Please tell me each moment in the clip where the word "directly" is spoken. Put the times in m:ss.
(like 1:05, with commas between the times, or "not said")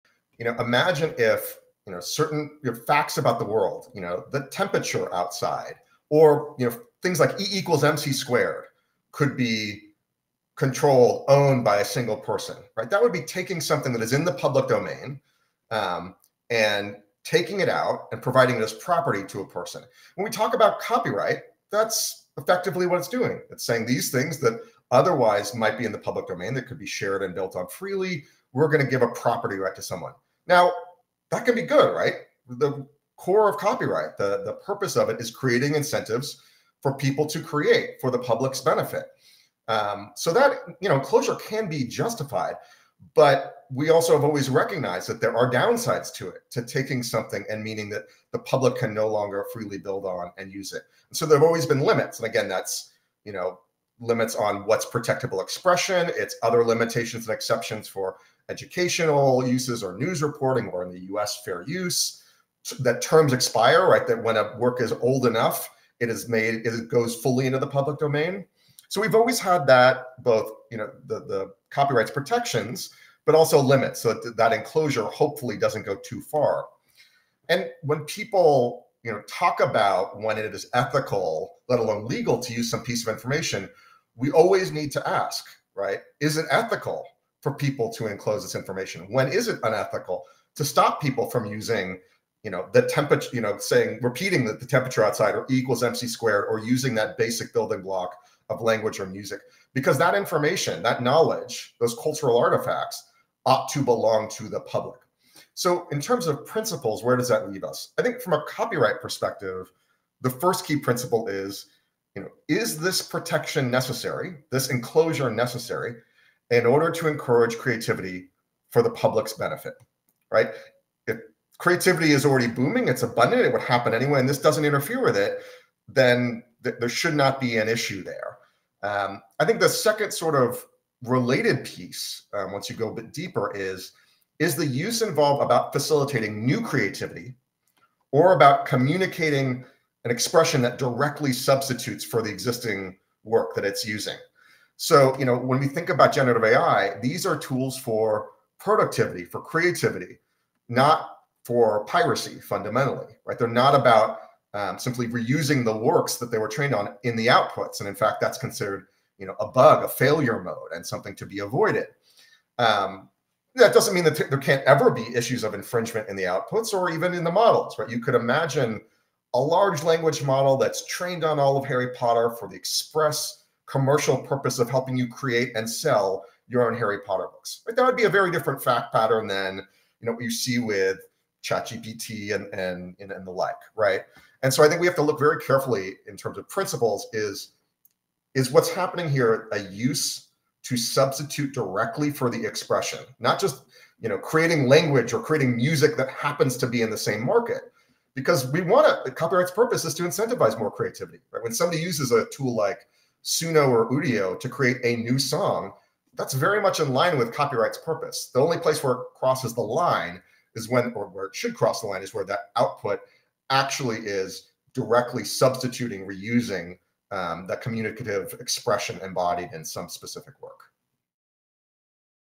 2:20, 3:11, 3:34.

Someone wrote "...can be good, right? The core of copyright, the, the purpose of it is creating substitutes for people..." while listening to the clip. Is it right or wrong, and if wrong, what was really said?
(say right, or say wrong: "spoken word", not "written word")
wrong: "incentives", not "substitutes".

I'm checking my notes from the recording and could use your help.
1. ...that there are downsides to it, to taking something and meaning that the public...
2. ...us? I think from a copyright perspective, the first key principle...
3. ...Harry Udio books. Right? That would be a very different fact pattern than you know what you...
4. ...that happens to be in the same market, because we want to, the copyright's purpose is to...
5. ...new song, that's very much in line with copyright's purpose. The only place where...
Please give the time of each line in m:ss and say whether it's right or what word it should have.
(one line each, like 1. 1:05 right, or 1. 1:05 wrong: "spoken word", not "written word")
1. 0:45 right
2. 1:47 right
3. 2:56 wrong: "Potter", not "Udio"
4. 3:15 right
5. 3:25 right.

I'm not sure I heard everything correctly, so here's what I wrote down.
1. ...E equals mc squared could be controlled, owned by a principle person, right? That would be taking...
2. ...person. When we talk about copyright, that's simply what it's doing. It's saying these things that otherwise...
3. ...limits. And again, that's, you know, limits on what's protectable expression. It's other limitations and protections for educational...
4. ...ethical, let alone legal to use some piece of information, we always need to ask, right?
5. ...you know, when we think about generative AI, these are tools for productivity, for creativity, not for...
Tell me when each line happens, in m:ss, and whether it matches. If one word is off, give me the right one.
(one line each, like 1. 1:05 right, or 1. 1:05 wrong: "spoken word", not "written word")
1. 0:07 wrong: "single", not "principle"
2. 0:19 wrong: "effectively", not "simply"
3. 0:51 wrong: "exceptions", not "protections"
4. 1:20 right
5. 2:25 right.